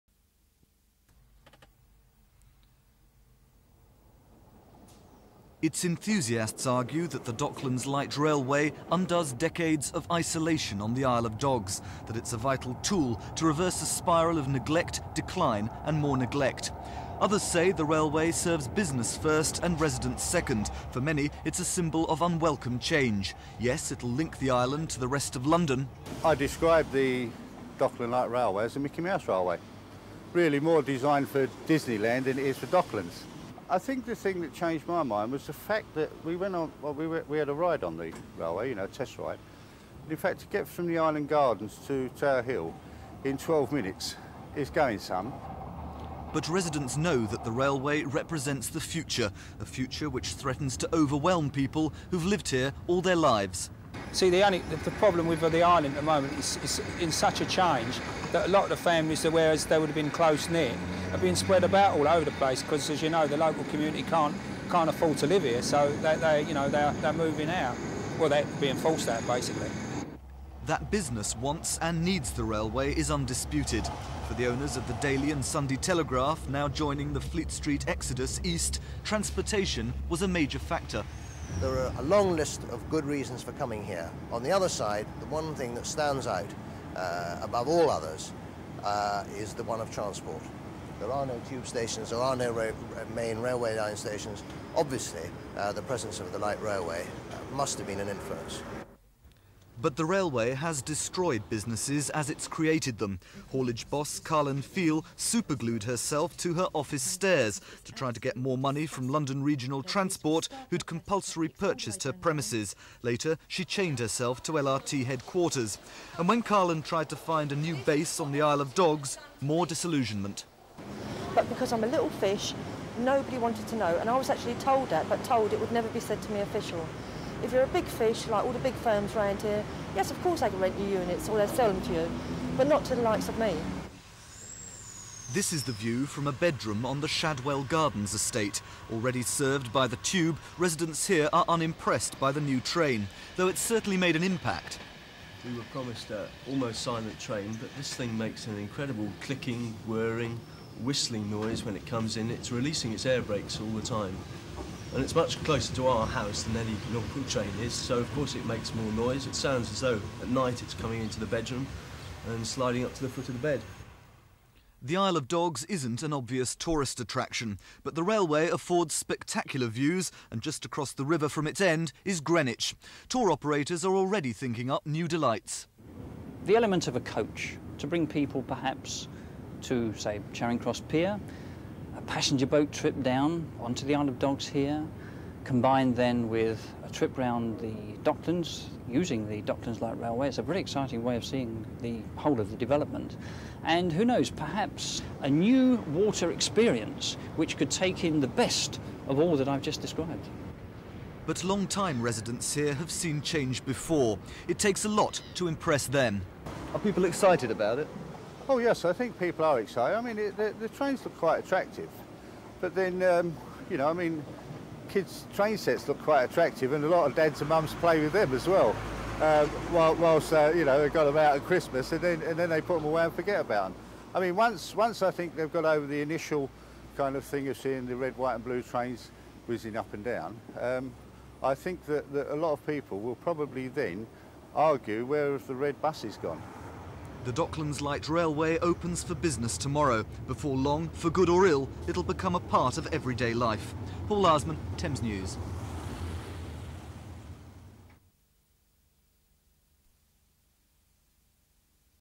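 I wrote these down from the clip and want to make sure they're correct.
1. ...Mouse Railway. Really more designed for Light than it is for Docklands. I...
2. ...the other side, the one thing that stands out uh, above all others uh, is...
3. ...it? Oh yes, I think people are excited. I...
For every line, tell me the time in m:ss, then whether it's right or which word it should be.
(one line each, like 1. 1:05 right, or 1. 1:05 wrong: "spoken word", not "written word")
1. 0:29 wrong: "Disneyland", not "Light"
2. 1:24 right
3. 3:27 right.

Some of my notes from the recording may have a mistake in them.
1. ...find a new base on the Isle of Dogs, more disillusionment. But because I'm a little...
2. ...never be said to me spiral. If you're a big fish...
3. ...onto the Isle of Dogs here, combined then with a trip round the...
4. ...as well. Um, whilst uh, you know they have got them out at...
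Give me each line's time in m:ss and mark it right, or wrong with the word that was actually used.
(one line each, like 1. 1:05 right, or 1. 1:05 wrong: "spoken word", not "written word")
1. 1:57 right
2. 2:05 wrong: "official", not "spiral"
3. 3:03 right
4. 3:38 right.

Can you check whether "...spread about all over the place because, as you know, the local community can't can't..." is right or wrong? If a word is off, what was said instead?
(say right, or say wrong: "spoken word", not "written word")
right.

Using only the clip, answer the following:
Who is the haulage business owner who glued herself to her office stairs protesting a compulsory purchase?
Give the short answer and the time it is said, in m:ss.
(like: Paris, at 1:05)
Carlin Feel, at 1:44.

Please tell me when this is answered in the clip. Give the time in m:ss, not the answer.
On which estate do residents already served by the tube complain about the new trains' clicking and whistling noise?
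2:17.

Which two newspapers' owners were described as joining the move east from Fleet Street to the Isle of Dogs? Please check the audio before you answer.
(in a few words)
Daily and Sunday Telegraph.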